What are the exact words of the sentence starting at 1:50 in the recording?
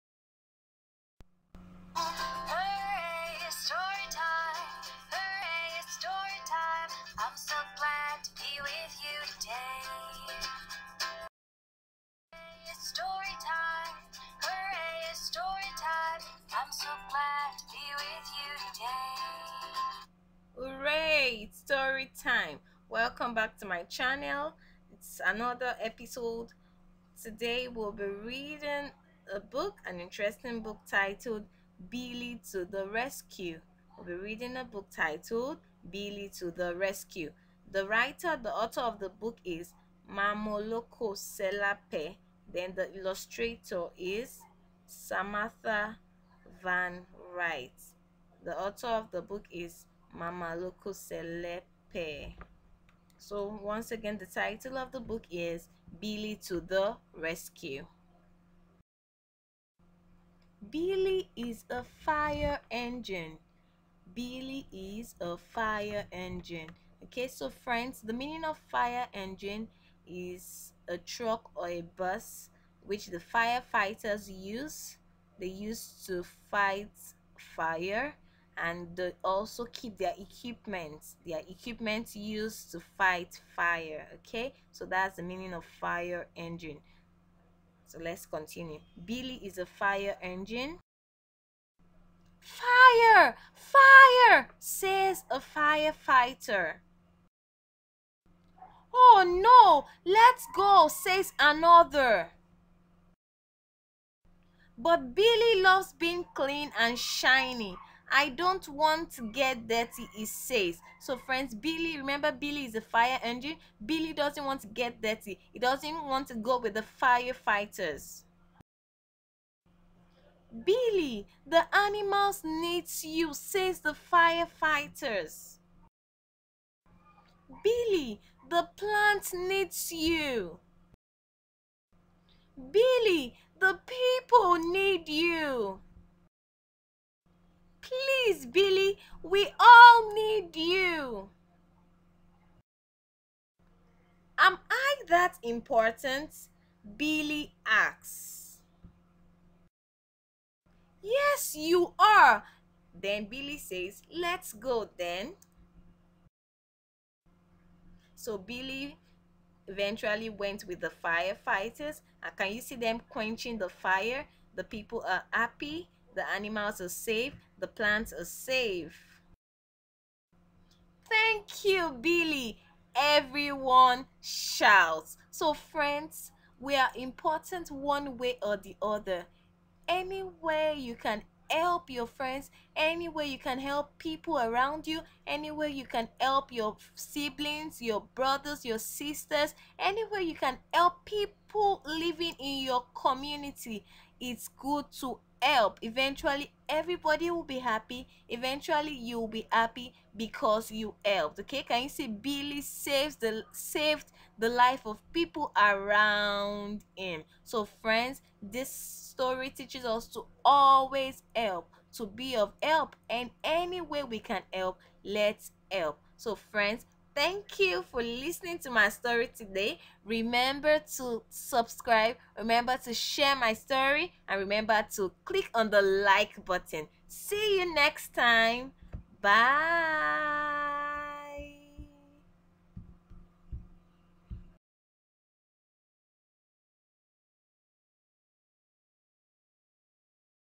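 So, friends, Billy, remember Billy is a fire engine.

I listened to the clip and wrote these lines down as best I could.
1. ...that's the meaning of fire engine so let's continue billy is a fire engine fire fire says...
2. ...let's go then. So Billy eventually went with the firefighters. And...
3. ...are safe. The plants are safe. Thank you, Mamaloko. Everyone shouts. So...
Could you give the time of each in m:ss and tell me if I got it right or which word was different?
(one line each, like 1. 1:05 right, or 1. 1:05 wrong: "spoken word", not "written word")
1. 1:24 right
2. 2:34 right
3. 2:46 wrong: "Billy", not "Mamaloko".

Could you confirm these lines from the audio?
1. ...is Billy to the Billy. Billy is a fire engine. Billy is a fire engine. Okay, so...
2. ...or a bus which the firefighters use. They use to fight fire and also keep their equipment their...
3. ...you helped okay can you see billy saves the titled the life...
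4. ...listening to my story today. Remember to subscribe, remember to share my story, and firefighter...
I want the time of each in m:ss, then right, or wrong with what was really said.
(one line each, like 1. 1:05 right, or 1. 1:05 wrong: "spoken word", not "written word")
1. 0:55 wrong: "Rescue", not "Billy"
2. 1:11 right
3. 3:20 wrong: "saved", not "titled"
4. 3:38 wrong: "remember", not "firefighter".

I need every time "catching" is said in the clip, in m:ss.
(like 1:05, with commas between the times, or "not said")
not said.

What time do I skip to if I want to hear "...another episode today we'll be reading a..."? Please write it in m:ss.
0:25.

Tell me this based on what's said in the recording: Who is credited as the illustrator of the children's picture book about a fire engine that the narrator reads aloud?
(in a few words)
Samantha van Wright.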